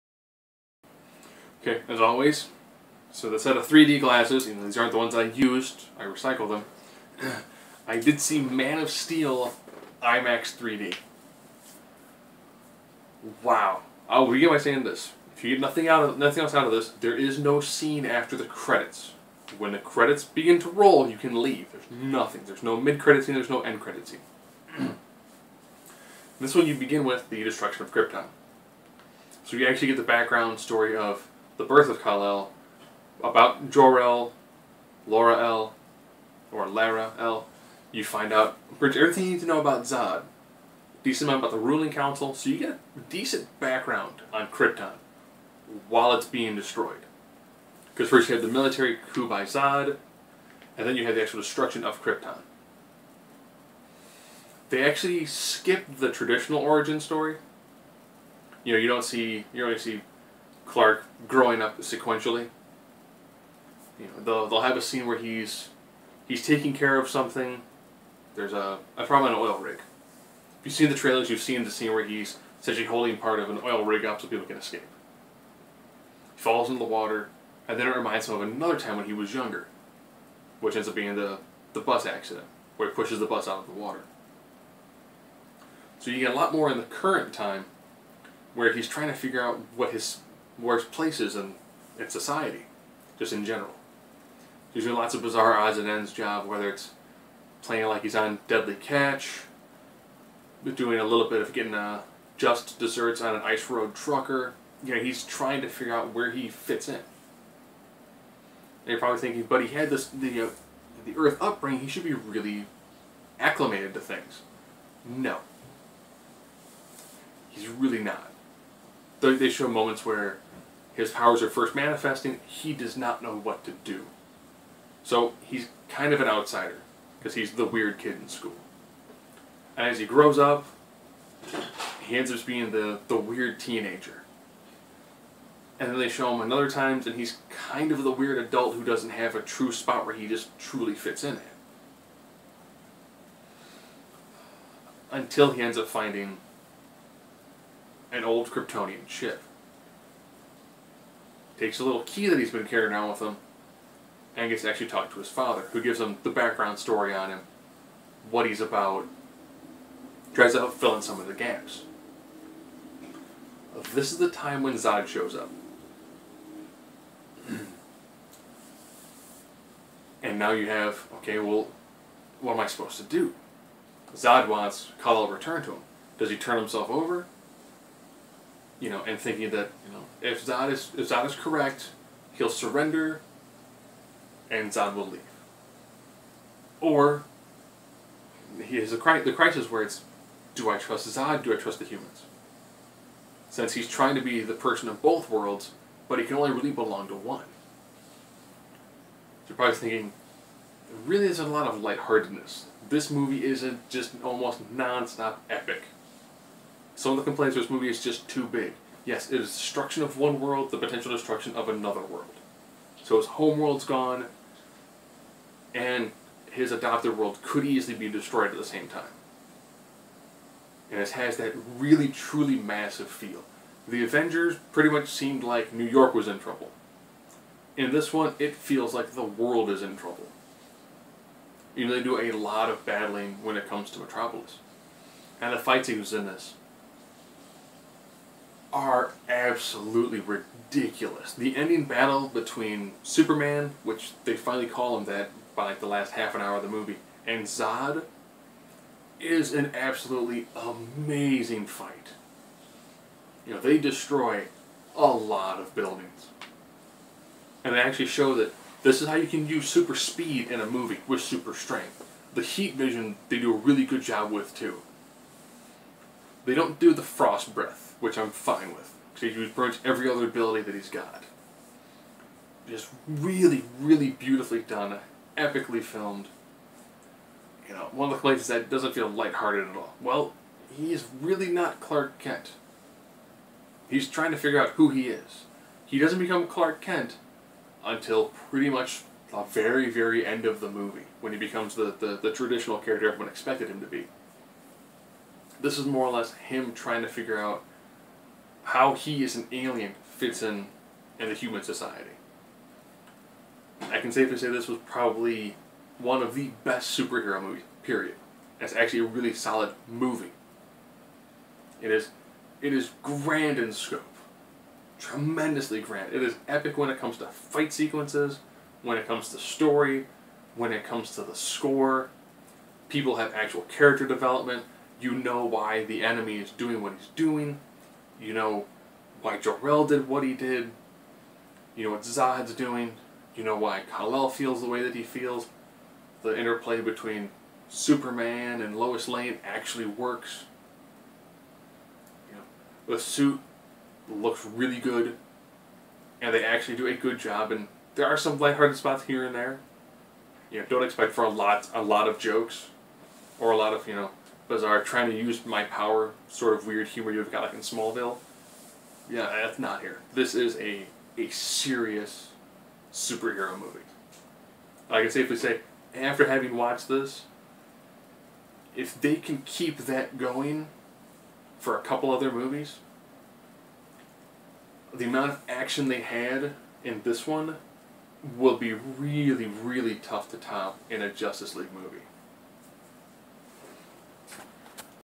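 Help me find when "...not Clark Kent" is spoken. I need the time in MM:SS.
04:41.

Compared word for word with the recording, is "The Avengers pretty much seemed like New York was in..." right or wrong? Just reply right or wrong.
right.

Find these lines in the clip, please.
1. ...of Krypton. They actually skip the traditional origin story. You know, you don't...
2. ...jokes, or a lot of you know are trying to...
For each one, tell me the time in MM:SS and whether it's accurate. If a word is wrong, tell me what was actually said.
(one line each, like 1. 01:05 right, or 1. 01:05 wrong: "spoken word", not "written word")
1. 00:51 right
2. 05:52 right.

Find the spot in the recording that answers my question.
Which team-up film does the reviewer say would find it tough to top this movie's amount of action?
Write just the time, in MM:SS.
06:21.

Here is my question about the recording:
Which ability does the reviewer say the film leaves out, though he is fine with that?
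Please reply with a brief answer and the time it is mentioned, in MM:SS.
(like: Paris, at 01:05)
Frost breath, at 04:27.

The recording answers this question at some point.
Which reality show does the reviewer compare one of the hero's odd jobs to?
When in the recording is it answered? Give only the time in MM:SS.
01:38.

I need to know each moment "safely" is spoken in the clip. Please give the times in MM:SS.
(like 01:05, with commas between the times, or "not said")
05:04, 06:05.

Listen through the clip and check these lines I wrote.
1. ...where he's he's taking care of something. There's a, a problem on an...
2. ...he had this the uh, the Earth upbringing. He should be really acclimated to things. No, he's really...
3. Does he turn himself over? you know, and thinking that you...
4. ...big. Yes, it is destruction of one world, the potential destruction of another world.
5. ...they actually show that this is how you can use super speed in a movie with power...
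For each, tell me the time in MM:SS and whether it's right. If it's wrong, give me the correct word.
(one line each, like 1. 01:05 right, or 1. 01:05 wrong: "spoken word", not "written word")
1. 01:05 right
2. 01:49 right
3. 02:56 right
4. 03:28 right
5. 04:17 wrong: "super", not "power".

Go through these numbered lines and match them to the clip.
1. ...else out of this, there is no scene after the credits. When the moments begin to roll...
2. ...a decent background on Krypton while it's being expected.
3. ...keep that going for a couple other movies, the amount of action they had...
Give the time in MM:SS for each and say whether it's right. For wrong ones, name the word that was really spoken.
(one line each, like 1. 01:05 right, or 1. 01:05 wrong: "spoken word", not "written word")
1. 00:16 wrong: "credits", not "moments"
2. 00:42 wrong: "destroyed", not "expected"
3. 06:09 right.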